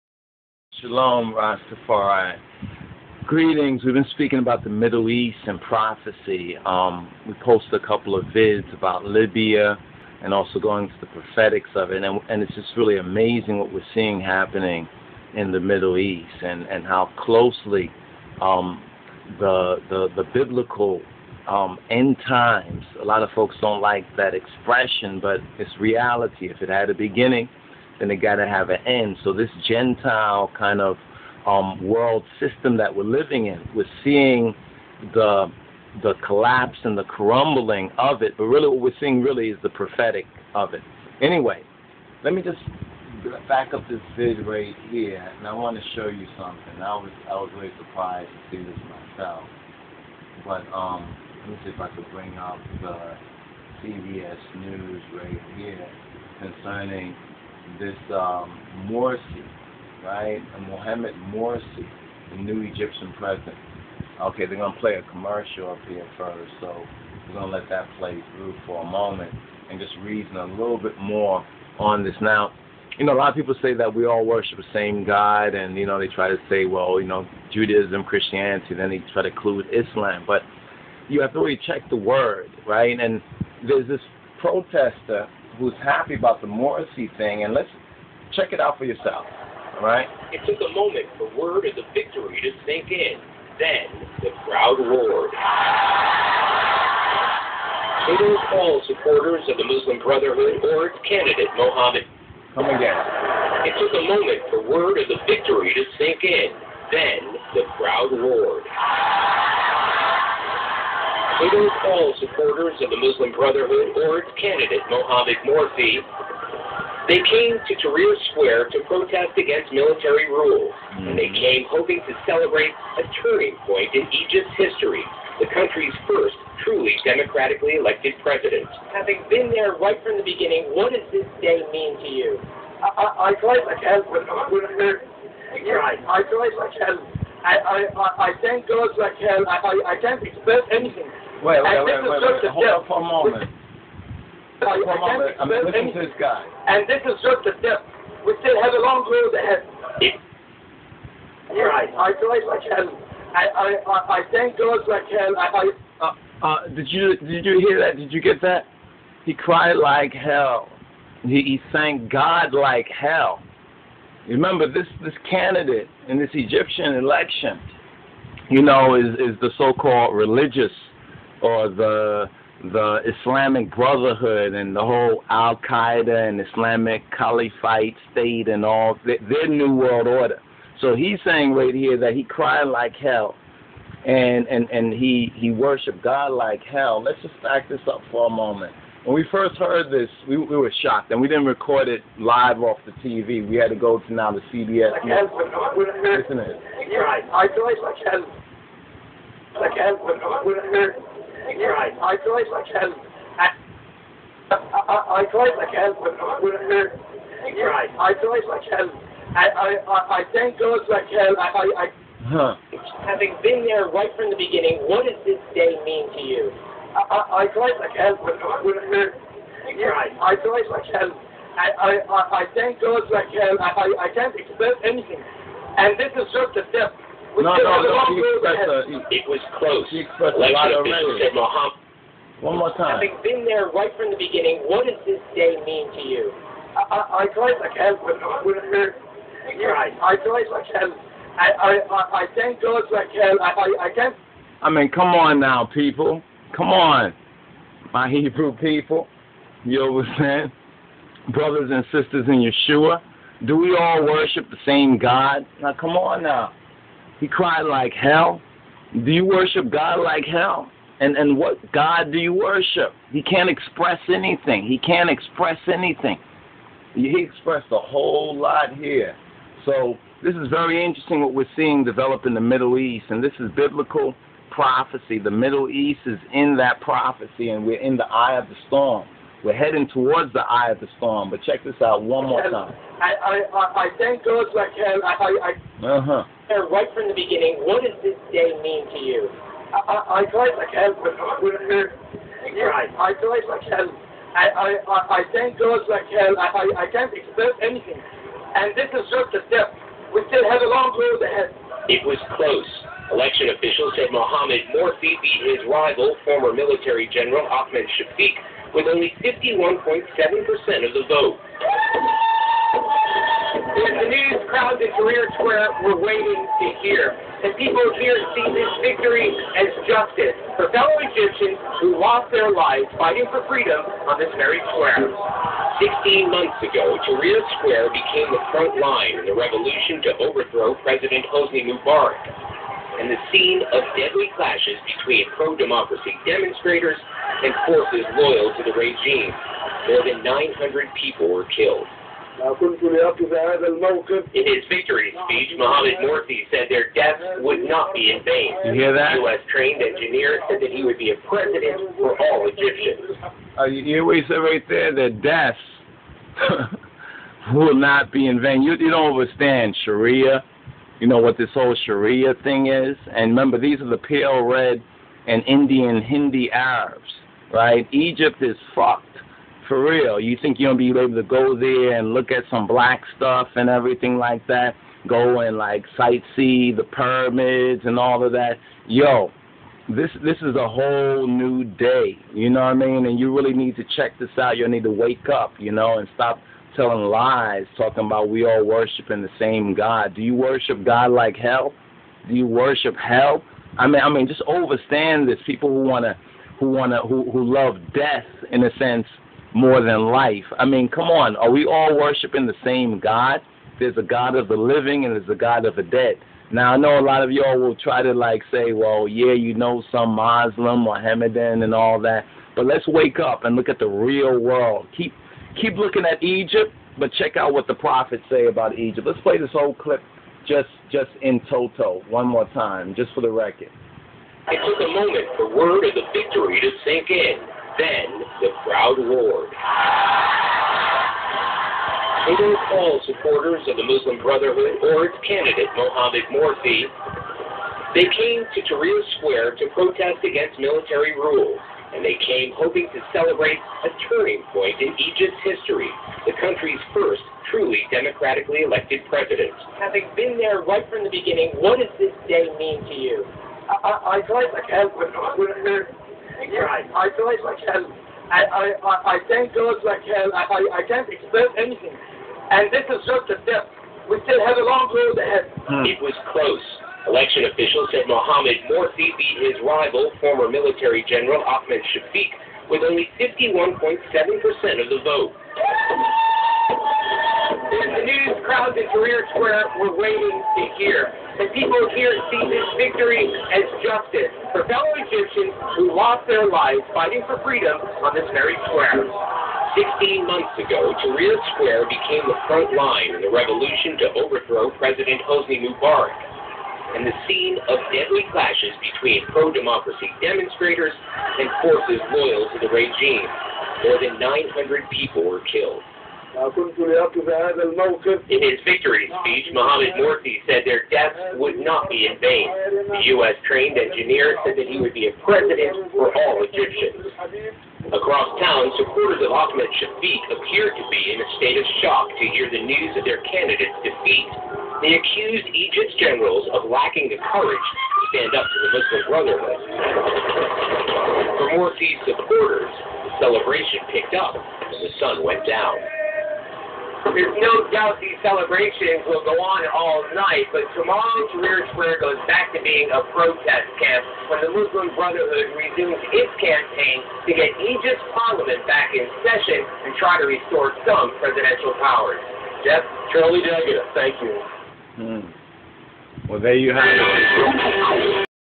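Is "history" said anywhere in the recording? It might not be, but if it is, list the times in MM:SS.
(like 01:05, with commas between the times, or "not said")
02:04, 07:25.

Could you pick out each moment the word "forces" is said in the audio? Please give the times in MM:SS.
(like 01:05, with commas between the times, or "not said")
05:37, 08:21.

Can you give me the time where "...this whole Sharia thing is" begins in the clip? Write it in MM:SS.
06:01.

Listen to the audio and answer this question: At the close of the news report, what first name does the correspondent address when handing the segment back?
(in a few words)
Jeff.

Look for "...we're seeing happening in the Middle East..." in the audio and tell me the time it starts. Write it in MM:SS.
00:13.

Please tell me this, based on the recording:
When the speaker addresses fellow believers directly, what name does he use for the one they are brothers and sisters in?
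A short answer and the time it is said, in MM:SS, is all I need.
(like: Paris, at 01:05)
Yeshua, at 04:12.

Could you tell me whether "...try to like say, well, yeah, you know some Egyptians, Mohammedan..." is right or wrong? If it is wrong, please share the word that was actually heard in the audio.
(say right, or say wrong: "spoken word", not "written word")
wrong: "Muslim", not "Egyptians".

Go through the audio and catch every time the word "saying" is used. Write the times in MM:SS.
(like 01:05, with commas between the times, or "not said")
03:01, 04:10.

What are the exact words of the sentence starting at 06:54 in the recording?
Keep keep looking at Egypt, but check out what the prophets say about Egypt.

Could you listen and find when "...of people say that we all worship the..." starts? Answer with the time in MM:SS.
01:13.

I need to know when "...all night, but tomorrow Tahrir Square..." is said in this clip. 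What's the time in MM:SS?
08:59.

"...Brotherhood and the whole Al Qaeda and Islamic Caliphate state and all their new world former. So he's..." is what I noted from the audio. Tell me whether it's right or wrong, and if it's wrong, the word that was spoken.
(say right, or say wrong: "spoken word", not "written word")
wrong: "order", not "former".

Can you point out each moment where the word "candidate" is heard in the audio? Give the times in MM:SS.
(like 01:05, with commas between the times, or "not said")
01:41, 01:54, 02:45, 07:15, 08:43.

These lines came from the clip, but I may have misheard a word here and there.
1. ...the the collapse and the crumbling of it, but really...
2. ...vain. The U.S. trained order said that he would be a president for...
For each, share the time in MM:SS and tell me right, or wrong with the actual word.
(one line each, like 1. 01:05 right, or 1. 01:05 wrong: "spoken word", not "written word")
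1. 00:35 right
2. 08:32 wrong: "engineer", not "order".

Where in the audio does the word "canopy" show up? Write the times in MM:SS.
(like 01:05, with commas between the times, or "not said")
not said.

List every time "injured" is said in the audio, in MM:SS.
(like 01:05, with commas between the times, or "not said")
not said.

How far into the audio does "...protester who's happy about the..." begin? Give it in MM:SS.
01:24.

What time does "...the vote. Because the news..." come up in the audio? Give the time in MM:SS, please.
05:10.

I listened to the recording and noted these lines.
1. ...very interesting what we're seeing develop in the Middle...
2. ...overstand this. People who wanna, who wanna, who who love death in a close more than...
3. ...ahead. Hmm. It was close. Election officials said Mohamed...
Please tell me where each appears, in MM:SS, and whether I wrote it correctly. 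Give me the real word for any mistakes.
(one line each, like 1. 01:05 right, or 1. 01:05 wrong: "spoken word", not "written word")
1. 04:30 right
2. 06:34 wrong: "sense", not "close"
3. 07:45 right.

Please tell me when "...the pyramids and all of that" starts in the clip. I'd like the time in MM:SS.
06:16.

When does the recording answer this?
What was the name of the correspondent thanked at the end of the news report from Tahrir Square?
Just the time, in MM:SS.
09:13.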